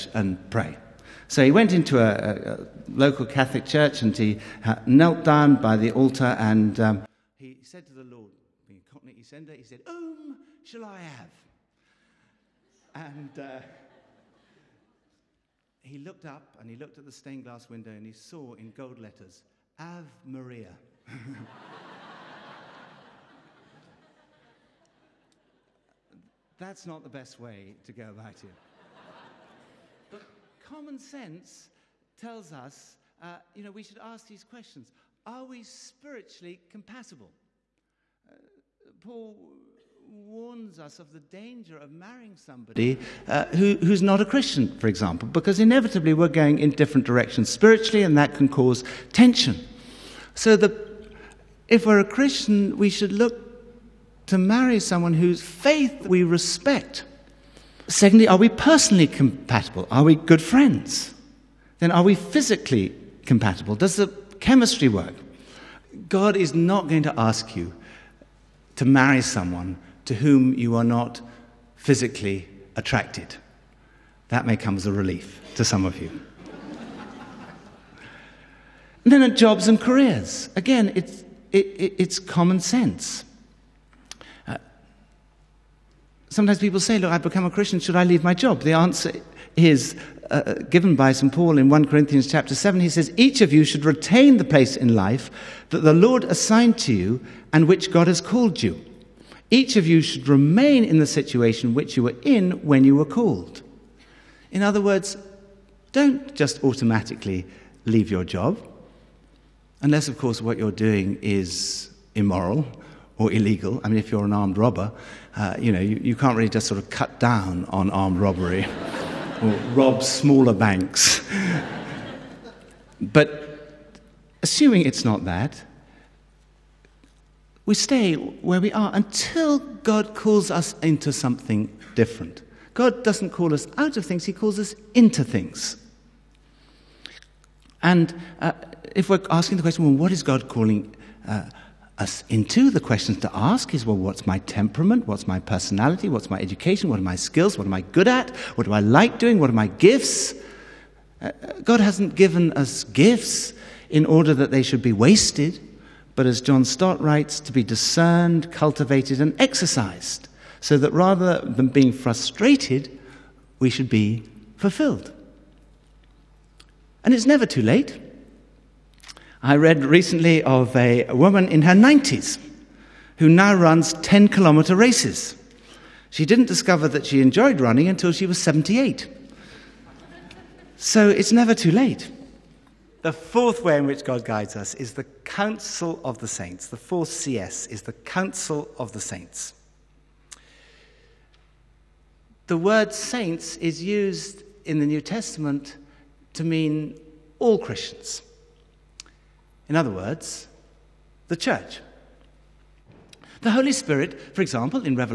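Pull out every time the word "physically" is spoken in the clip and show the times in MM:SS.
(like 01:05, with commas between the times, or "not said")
01:02, 01:11.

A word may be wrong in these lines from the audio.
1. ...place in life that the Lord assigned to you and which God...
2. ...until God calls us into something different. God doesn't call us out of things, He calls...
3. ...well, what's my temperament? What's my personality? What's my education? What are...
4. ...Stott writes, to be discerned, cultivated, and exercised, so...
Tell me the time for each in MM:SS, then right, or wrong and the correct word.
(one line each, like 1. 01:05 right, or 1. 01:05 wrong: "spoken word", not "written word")
1. 01:34 right
2. 02:08 right
3. 02:23 right
4. 02:36 right.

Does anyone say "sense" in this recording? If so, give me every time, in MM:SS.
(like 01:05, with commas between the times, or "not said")
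00:30, 01:22.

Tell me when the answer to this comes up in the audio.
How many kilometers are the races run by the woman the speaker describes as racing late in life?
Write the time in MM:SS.
02:53.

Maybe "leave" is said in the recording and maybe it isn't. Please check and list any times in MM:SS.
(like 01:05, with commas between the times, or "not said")
01:28, 01:47.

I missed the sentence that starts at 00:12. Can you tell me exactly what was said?
And uh, he looked up and he looked at the stained glass window and he saw in gold letters, Ave Maria.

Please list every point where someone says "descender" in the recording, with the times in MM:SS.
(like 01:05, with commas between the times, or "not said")
00:09.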